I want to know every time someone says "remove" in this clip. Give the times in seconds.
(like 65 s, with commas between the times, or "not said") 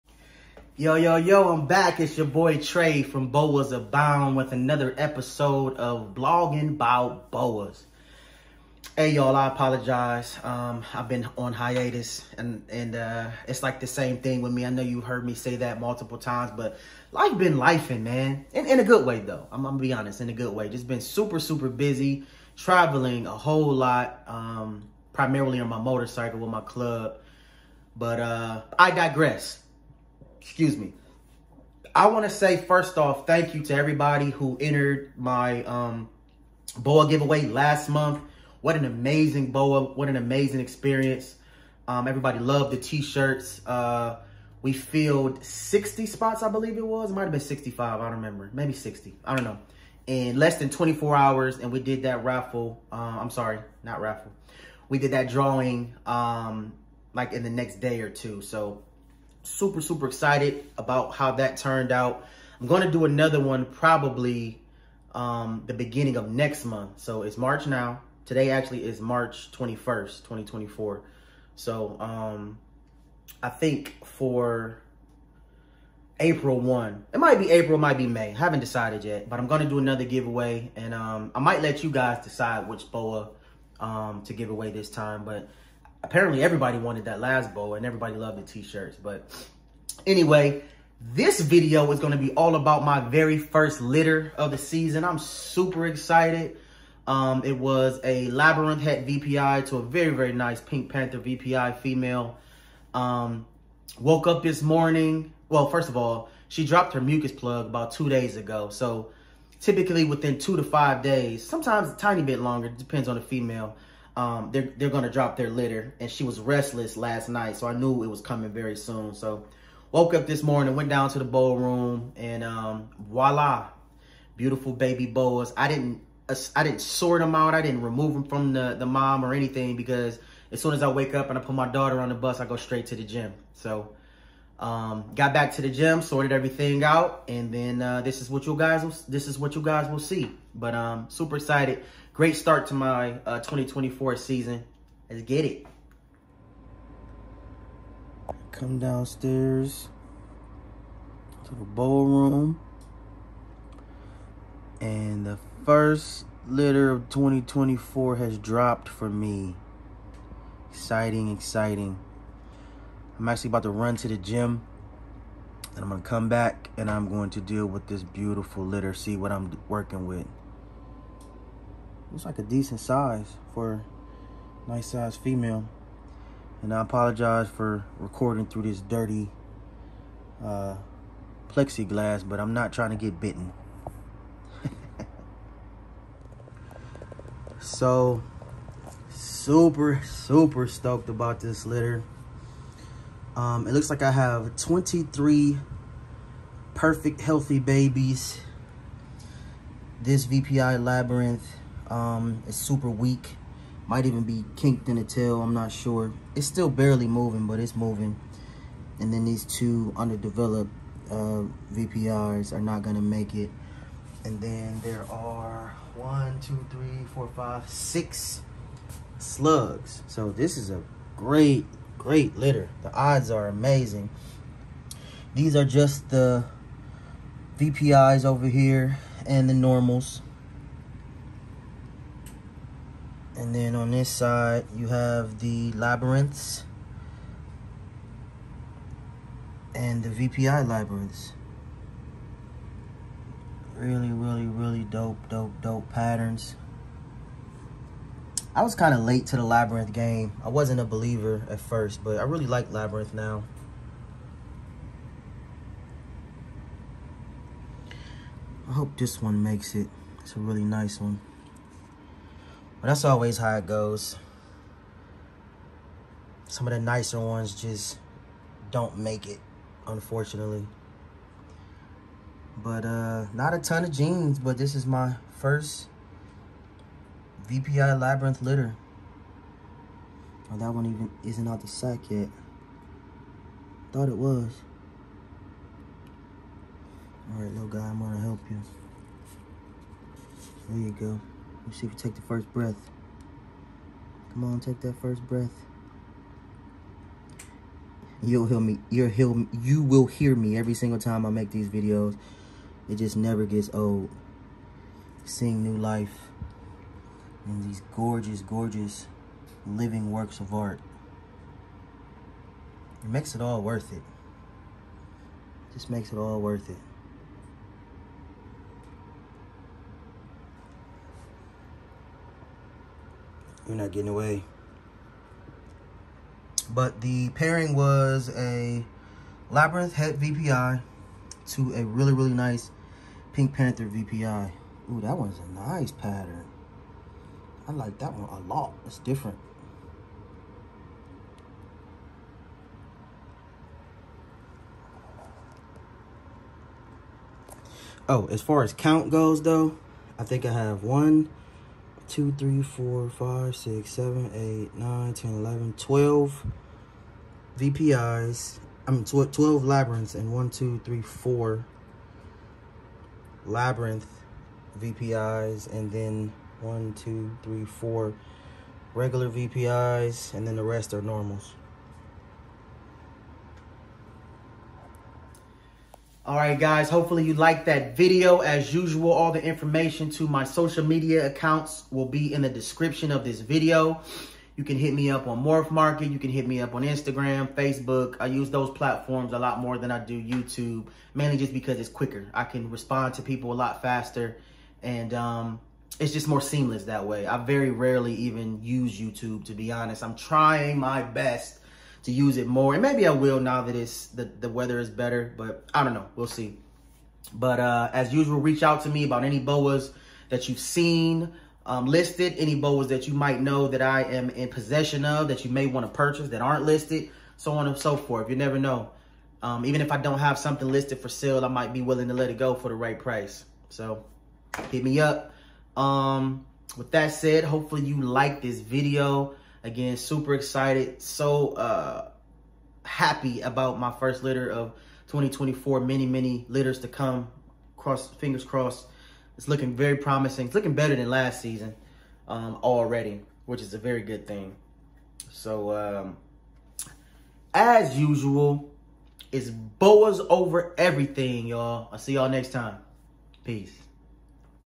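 127 s.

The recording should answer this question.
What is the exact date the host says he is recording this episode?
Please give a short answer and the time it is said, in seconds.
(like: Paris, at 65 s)
March 21st, 2024, at 69 s.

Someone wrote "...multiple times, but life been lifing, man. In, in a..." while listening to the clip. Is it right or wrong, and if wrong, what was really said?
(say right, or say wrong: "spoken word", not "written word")
right.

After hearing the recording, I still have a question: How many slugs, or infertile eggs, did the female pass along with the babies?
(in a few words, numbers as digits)
6.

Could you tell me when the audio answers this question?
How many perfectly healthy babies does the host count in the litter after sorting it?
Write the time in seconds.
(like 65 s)
194 s.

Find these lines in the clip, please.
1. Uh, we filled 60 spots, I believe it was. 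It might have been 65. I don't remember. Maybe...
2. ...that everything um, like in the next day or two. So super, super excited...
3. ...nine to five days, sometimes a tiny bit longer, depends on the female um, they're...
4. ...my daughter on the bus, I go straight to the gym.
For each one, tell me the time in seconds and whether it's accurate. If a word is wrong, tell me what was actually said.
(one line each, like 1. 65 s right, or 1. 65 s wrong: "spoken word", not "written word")
1. 43 s right
2. 55 s wrong: "drawing", not "everything"
3. 110 s wrong: "two", not "nine"
4. 131 s right.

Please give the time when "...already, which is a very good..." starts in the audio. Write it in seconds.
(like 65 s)
442 s.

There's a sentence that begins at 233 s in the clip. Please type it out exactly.
And then on this side, you have the labyrinths and the VPI labyrinths.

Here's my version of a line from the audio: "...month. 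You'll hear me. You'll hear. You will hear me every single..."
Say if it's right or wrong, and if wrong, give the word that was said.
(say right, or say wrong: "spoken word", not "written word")
wrong: "breath", not "month".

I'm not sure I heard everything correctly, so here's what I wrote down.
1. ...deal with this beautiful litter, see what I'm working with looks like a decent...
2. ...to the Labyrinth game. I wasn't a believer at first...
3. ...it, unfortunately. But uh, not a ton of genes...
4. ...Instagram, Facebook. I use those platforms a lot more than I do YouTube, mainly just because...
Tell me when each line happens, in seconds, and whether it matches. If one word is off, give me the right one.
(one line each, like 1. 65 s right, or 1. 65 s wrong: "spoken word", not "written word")
1. 167 s right
2. 249 s right
3. 269 s right
4. 386 s right.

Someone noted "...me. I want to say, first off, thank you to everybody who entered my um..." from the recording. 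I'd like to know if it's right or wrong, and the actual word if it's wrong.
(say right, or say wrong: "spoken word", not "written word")
right.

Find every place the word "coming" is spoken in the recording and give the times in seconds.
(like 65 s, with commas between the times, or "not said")
118 s.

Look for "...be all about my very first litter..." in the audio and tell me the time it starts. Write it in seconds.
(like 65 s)
92 s.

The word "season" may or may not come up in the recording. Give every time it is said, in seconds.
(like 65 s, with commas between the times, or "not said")
94 s, 144 s, 441 s.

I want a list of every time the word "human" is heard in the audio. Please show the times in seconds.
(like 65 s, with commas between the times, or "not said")
not said.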